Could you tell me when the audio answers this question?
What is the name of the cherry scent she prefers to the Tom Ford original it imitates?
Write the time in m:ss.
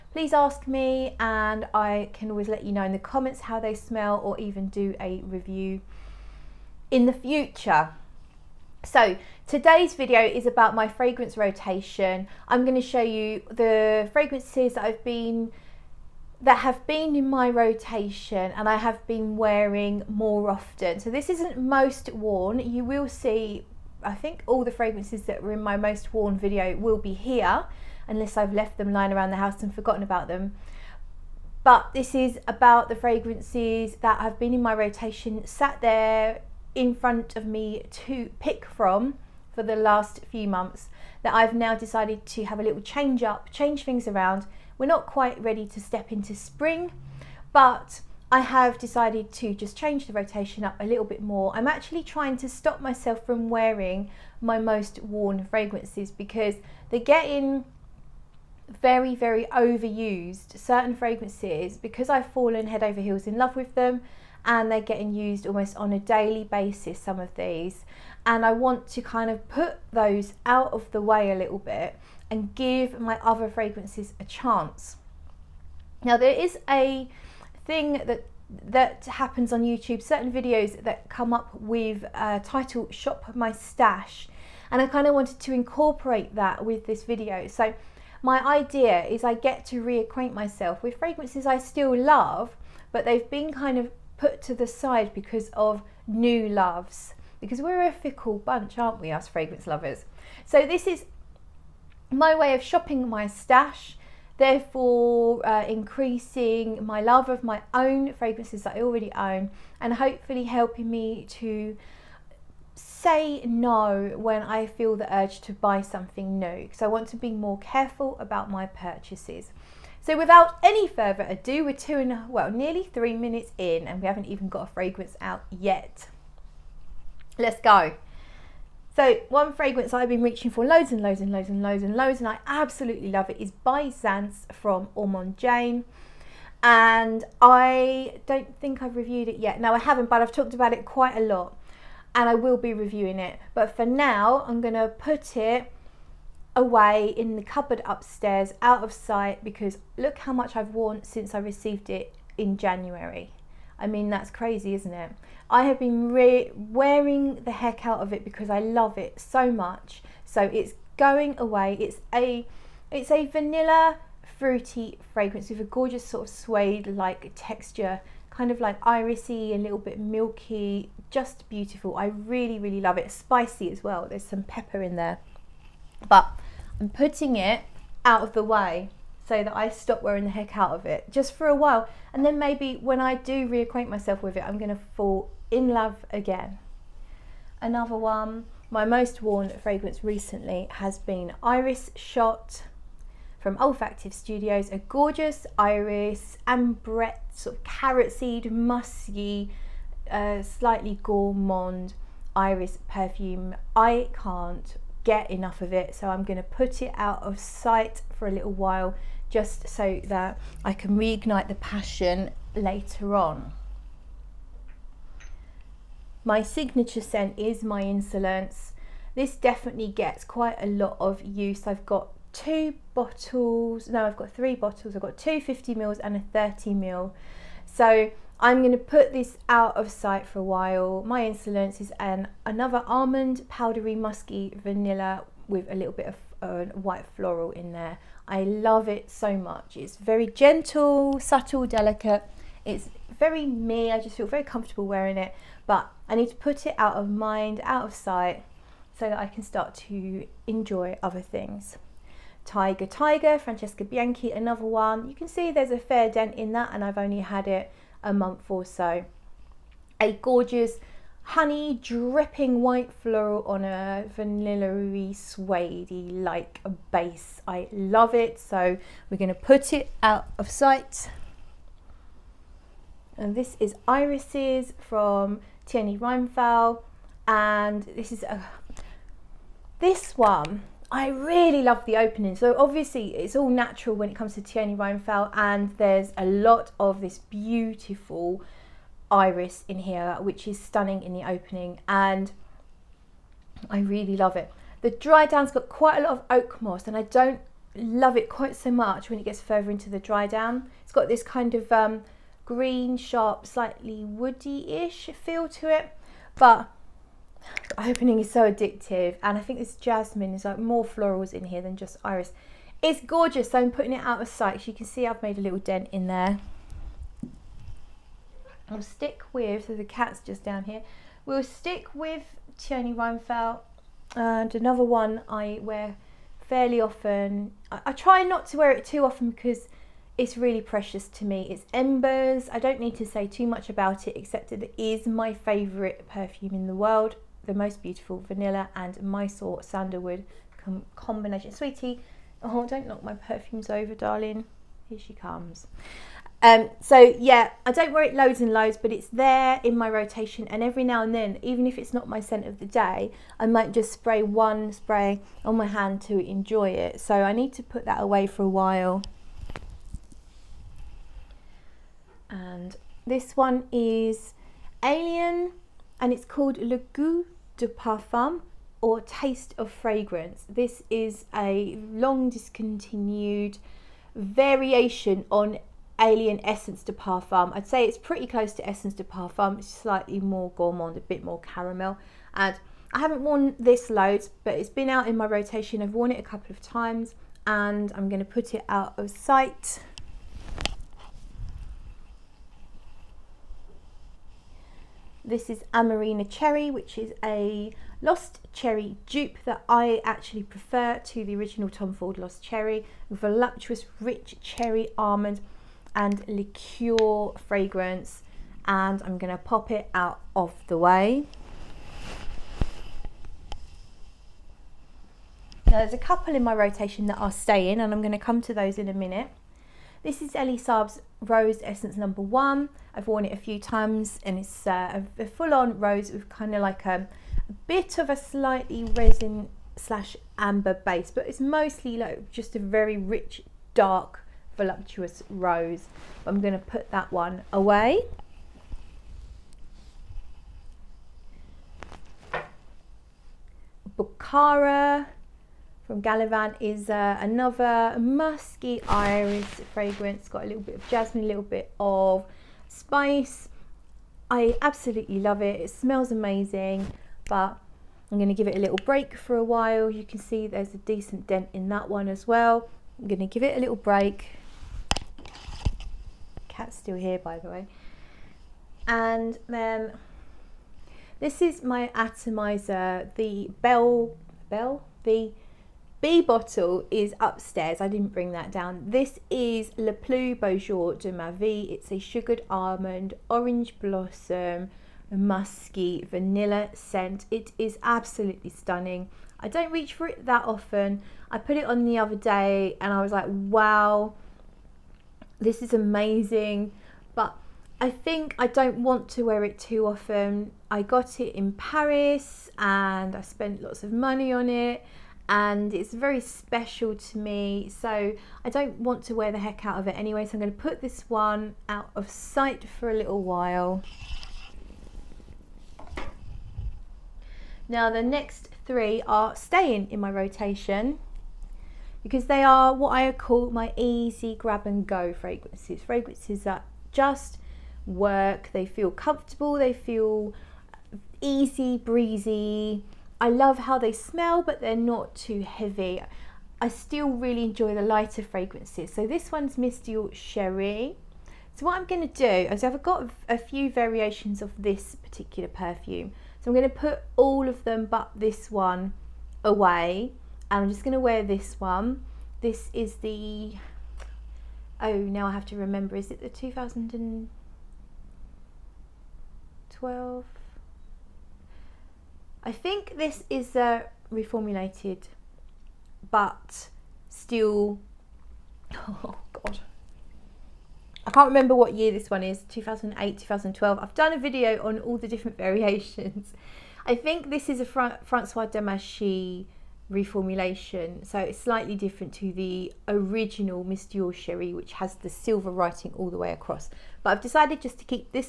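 6:35.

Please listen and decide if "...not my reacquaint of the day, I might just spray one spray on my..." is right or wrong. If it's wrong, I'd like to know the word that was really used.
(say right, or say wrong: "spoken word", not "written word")
wrong: "scent", not "reacquaint".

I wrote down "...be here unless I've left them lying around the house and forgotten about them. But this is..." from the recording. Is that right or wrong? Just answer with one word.
right.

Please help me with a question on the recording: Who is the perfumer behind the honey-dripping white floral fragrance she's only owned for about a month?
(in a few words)
Francesca Bianchi.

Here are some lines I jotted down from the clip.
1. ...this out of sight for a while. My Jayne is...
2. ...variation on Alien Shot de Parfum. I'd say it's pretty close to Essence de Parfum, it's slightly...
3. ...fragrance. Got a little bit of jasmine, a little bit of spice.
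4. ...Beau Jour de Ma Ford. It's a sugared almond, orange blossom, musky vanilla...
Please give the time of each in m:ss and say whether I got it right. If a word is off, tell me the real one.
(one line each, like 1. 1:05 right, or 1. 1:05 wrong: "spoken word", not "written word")
1. 3:49 wrong: "Insolence", not "Jayne"
2. 6:14 wrong: "Essence", not "Shot"
3. 7:29 right
4. 8:00 wrong: "Vie", not "Ford".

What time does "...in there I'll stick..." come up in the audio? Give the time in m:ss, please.
5:15.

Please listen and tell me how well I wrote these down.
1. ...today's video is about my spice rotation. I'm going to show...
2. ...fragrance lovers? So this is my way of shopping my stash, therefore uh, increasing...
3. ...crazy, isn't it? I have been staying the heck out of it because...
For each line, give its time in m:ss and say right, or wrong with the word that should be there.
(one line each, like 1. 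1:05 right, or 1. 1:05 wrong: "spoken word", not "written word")
1. 0:09 wrong: "fragrance", not "spice"
2. 1:39 right
3. 2:34 wrong: "wearing", not "staying".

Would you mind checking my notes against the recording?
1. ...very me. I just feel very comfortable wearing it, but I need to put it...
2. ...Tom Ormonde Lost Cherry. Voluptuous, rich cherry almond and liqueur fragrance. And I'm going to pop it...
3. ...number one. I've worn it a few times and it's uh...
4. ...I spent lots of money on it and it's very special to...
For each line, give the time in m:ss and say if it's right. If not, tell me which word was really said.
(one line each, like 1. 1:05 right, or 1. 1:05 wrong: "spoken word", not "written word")
1. 4:03 right
2. 6:41 wrong: "Ford", not "Ormonde"
3. 7:01 right
4. 8:23 right.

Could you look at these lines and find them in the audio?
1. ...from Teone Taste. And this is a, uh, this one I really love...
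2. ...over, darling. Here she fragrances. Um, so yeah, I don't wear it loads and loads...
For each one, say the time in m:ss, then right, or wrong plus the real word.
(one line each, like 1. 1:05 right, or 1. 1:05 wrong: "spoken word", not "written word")
1. 4:34 wrong: "Reinthal", not "Taste"
2. 5:43 wrong: "comes", not "fragrances".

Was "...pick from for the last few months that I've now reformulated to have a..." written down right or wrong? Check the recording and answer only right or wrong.
wrong.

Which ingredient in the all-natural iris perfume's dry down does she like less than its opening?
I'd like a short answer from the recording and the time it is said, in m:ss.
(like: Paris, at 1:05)
oak moss, at 4:56.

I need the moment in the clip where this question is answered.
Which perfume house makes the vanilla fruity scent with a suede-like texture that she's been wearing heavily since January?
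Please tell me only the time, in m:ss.
2:14.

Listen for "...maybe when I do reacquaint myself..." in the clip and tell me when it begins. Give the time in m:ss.
3:02.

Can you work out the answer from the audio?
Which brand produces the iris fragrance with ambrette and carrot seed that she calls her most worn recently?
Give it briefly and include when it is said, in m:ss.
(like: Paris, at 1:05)
Olfactive Studios, at 3:13.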